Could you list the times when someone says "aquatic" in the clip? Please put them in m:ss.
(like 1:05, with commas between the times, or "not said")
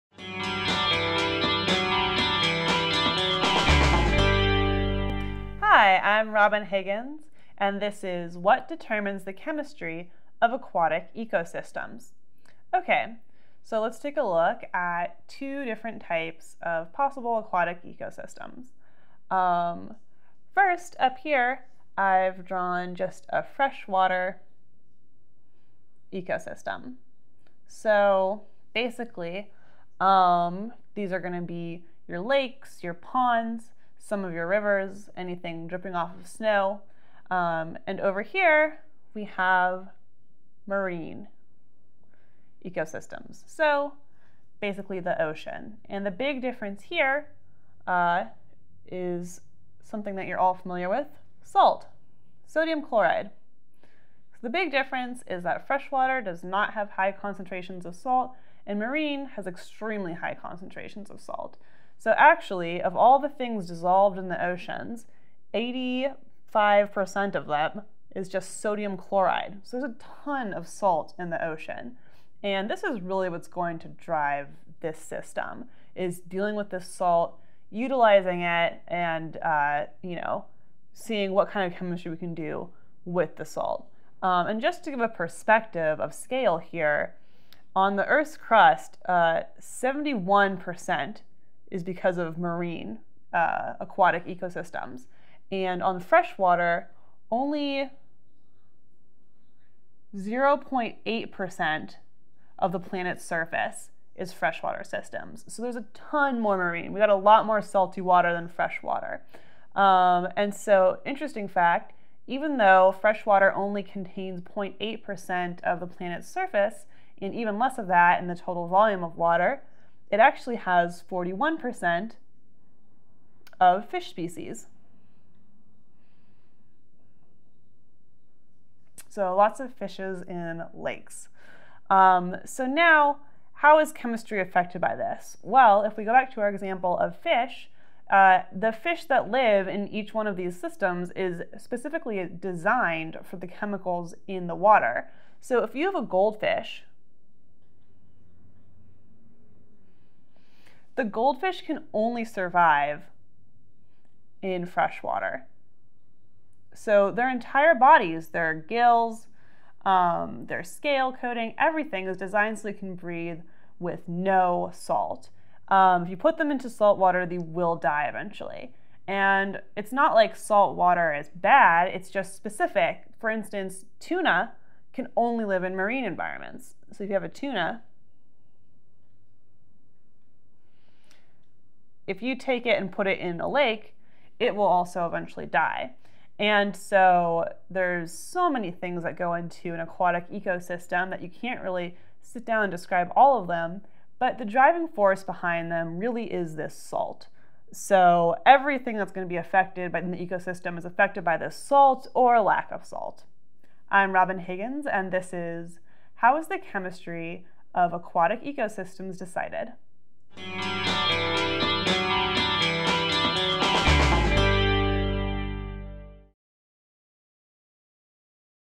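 0:10, 0:17, 1:33, 3:09, 3:27.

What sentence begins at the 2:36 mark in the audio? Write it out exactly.
So their entire bodies, their gills, um, their scale coating, everything is designed so they can breathe with no salt.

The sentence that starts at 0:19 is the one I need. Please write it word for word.
Um, first, up here, I've drawn just a freshwater ecosystem.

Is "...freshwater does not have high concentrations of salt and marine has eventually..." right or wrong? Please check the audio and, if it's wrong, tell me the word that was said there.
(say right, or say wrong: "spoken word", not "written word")
wrong: "extremely", not "eventually".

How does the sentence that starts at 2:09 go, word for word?
So lots of fishes in lakes.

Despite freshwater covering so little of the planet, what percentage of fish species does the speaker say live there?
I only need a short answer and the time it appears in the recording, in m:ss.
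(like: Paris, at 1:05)
41%, at 2:01.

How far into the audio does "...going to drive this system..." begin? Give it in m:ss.
1:13.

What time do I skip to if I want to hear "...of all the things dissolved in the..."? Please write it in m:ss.
1:02.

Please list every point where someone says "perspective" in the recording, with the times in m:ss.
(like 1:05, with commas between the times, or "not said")
1:25.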